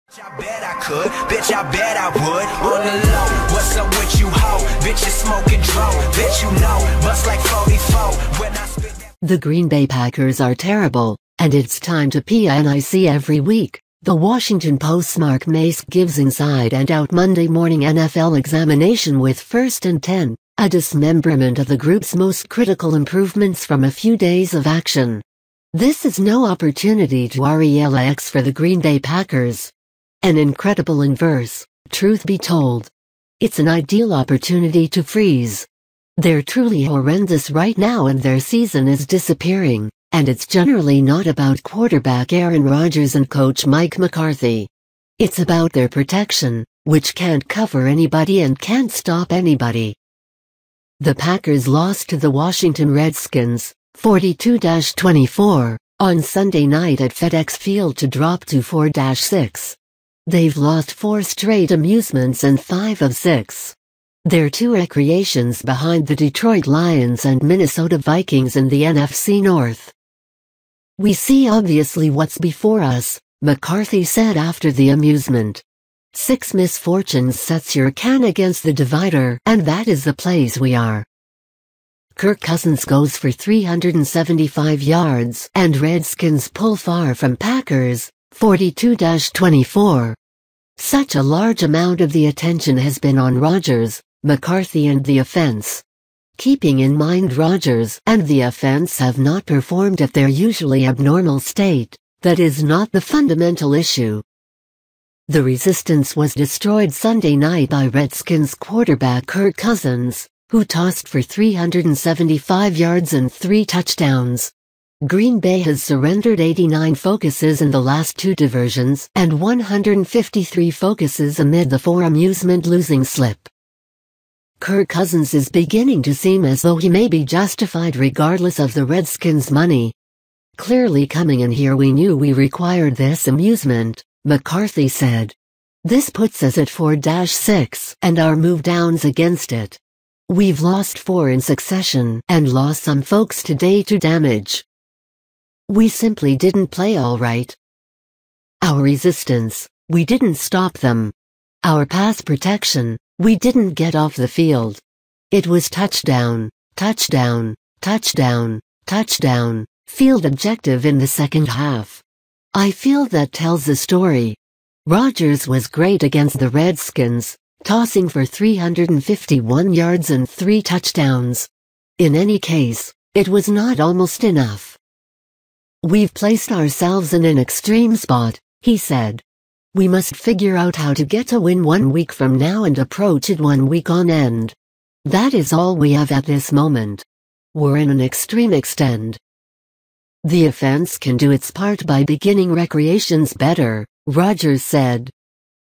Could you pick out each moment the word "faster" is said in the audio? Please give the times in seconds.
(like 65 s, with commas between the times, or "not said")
not said.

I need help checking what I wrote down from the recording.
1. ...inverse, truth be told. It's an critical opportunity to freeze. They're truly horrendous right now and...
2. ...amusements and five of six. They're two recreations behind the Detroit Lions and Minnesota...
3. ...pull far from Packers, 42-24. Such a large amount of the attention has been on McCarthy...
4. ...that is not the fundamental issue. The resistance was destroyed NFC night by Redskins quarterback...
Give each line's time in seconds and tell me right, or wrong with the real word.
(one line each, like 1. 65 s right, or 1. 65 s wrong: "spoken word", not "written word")
1. 31 s wrong: "ideal", not "critical"
2. 61 s right
3. 86 s wrong: "Rodgers", not "McCarthy"
4. 102 s wrong: "Sunday", not "NFC".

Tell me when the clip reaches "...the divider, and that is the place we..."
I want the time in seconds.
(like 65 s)
78 s.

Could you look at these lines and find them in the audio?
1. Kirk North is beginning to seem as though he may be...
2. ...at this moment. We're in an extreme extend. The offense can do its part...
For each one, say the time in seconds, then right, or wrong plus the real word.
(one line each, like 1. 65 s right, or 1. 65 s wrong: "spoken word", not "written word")
1. 124 s wrong: "Cousins", not "North"
2. 186 s right.